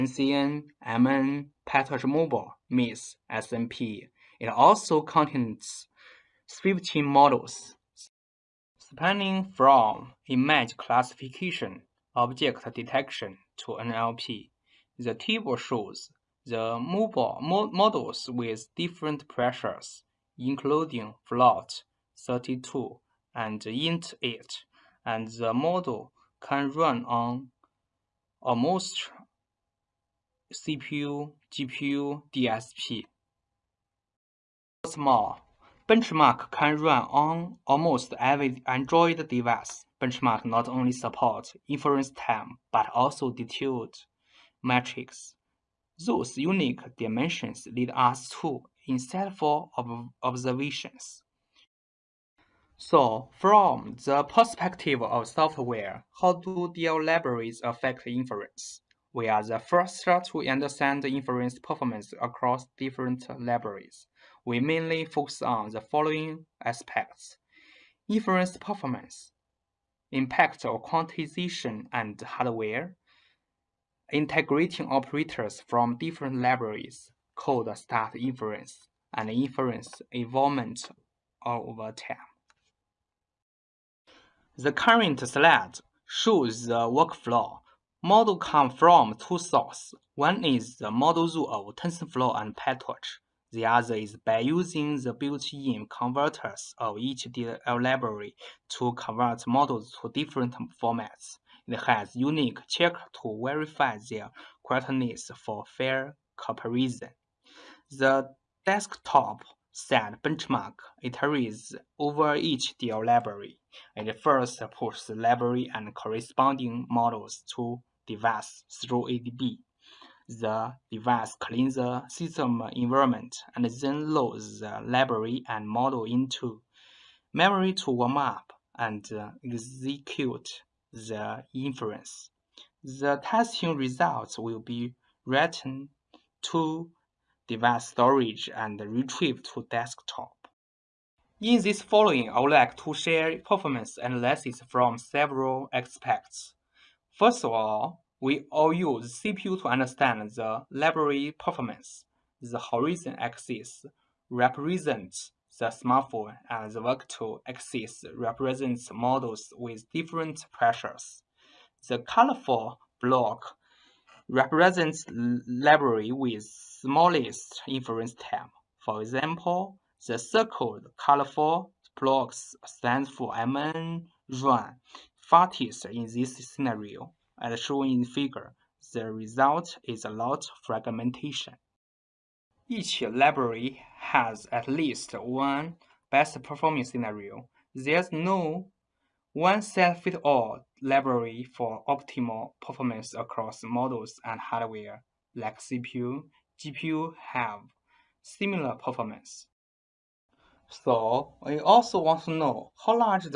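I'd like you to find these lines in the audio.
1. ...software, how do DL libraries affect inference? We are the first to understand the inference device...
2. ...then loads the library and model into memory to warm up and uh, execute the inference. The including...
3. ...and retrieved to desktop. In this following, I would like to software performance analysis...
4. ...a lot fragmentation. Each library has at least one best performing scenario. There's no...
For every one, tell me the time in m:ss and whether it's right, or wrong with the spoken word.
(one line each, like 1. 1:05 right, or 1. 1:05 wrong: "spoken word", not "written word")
1. 0:55 wrong: "performance", not "device"
2. 2:03 wrong: "testing", not "including"
3. 2:18 wrong: "share", not "software"
4. 3:00 right.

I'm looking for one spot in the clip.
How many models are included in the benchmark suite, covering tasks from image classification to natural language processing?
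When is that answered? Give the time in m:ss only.
0:06.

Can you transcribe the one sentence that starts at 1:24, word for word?
The current slide shows the workflow Model come from two sources.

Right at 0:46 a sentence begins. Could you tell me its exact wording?
Those unique dimensions lead us to insightful ob observations.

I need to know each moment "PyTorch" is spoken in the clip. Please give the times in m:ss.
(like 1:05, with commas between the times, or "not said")
0:01, 1:32.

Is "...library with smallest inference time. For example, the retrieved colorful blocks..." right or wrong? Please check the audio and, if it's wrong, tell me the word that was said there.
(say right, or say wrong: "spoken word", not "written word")
wrong: "circled", not "retrieved".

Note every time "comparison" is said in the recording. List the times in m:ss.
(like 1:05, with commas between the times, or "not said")
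1:46.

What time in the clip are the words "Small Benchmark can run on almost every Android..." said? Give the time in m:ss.
0:34.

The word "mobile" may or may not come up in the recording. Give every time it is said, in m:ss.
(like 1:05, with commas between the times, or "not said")
0:02, 0:16.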